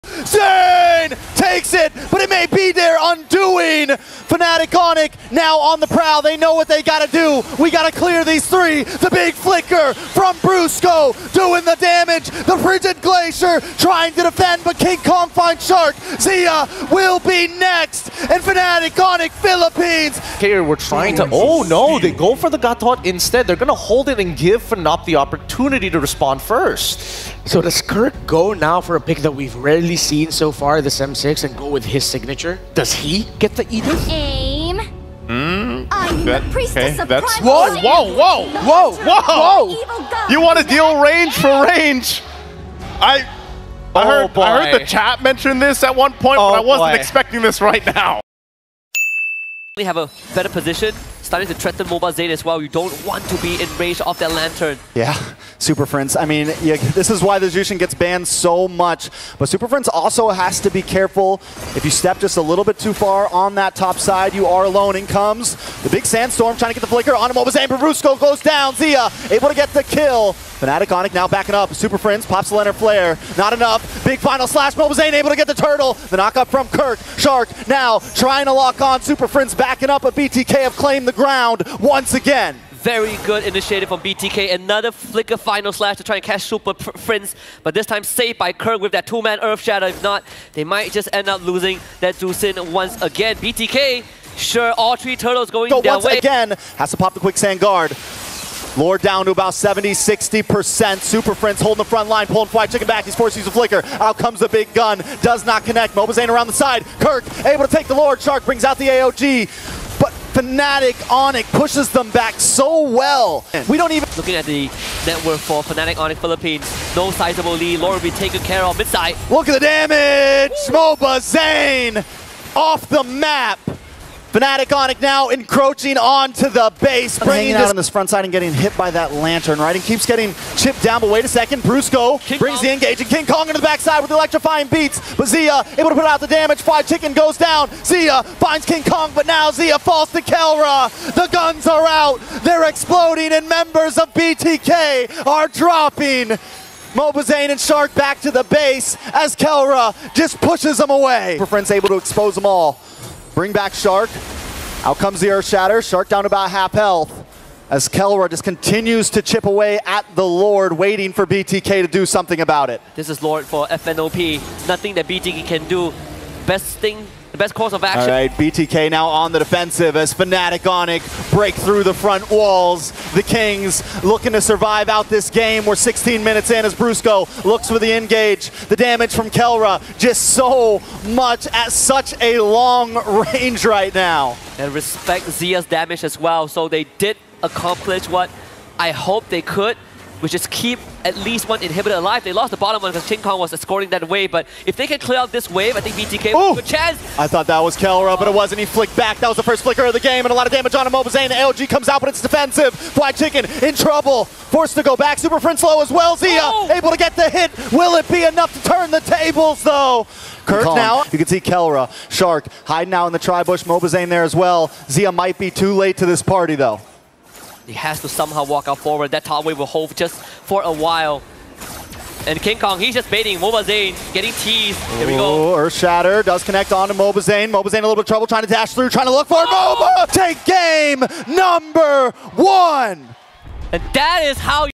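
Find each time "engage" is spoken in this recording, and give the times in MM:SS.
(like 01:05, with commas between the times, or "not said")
02:12, 02:57.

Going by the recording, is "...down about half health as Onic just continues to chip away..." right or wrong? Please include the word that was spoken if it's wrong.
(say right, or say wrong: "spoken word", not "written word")
wrong: "Kelra", not "Onic".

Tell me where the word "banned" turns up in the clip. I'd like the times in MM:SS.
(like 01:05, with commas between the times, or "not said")
00:57.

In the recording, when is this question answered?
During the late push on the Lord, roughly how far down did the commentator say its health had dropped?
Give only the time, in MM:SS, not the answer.
01:39.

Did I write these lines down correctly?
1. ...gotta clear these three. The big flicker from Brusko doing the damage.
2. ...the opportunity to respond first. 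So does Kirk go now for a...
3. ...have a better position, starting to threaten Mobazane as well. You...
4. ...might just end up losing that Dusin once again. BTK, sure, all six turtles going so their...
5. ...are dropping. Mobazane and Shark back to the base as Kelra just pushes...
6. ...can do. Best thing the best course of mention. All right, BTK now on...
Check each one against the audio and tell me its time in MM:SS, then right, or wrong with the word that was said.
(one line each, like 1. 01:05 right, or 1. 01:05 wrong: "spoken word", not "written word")
1. 00:07 right
2. 00:25 right
3. 00:49 right
4. 01:30 wrong: "three", not "six"
5. 02:25 right
6. 02:45 wrong: "action", not "mention".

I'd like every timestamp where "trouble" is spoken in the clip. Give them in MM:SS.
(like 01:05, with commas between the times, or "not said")
03:23, 03:48.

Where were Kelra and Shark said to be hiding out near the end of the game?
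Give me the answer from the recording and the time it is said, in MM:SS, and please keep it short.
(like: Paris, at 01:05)
tri-bush, at 03:33.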